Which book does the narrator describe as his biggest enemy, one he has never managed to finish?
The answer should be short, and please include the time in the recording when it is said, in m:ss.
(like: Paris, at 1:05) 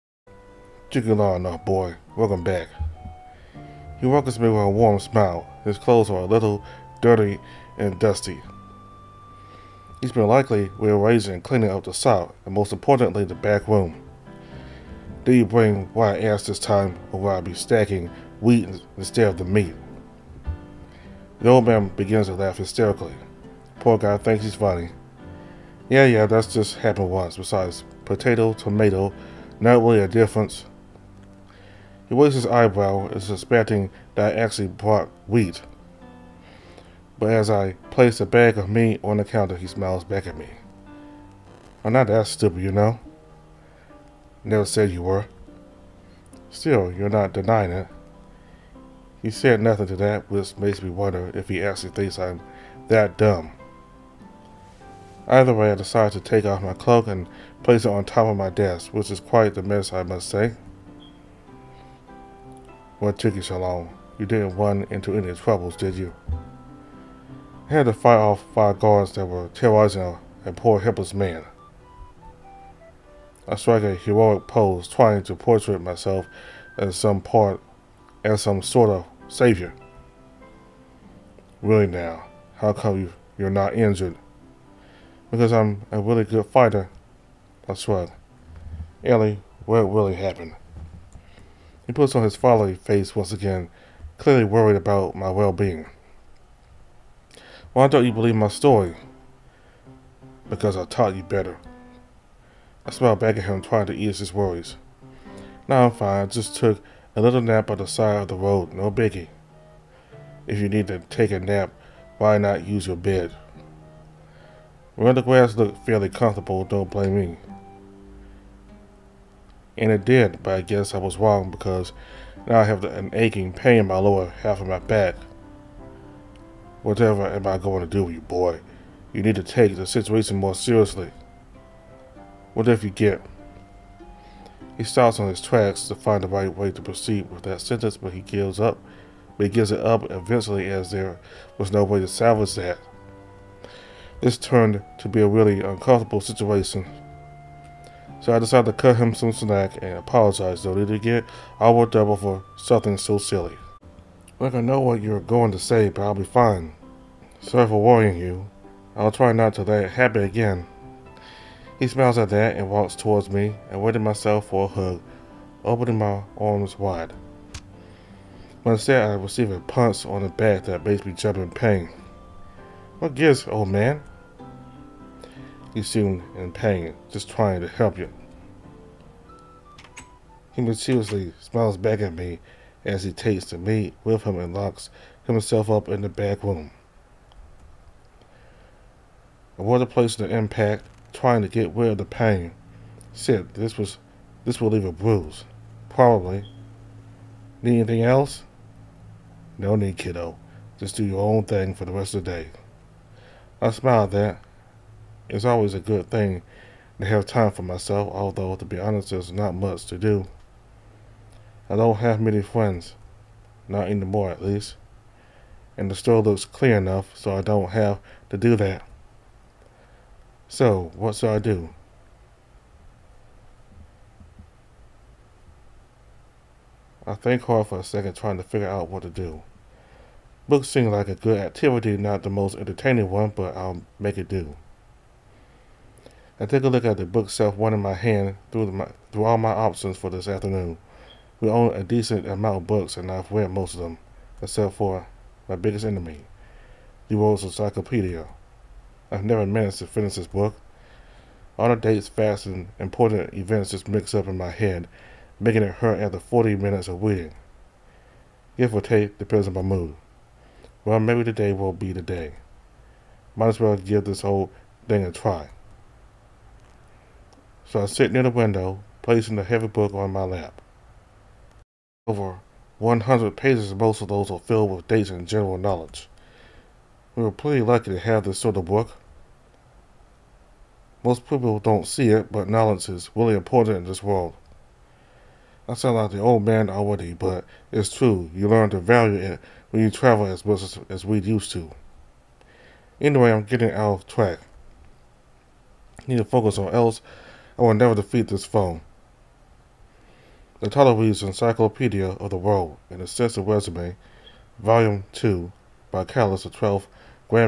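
World's Encyclopedia, at 4:07.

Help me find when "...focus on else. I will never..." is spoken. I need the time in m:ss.
4:56.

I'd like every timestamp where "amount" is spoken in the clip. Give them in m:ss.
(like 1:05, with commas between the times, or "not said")
4:02.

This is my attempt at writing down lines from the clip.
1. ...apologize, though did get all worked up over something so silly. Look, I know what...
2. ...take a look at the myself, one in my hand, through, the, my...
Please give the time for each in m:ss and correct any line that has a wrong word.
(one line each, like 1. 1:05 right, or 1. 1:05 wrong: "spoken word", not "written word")
1. 2:29 right
2. 3:56 wrong: "bookshelf", not "myself".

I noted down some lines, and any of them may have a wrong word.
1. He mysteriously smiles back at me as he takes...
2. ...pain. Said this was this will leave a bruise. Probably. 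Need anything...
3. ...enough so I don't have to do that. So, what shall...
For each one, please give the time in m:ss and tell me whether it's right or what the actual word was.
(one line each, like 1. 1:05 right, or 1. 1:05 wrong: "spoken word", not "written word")
1. 3:00 right
2. 3:12 right
3. 3:36 right.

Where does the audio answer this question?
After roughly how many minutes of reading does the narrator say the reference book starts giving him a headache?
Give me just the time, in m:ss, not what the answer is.
4:16.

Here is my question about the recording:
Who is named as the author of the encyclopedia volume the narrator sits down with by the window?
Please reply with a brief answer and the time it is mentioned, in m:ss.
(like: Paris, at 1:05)
Callis the 12th, at 5:06.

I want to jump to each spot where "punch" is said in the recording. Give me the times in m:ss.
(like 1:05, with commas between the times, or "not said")
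2:49.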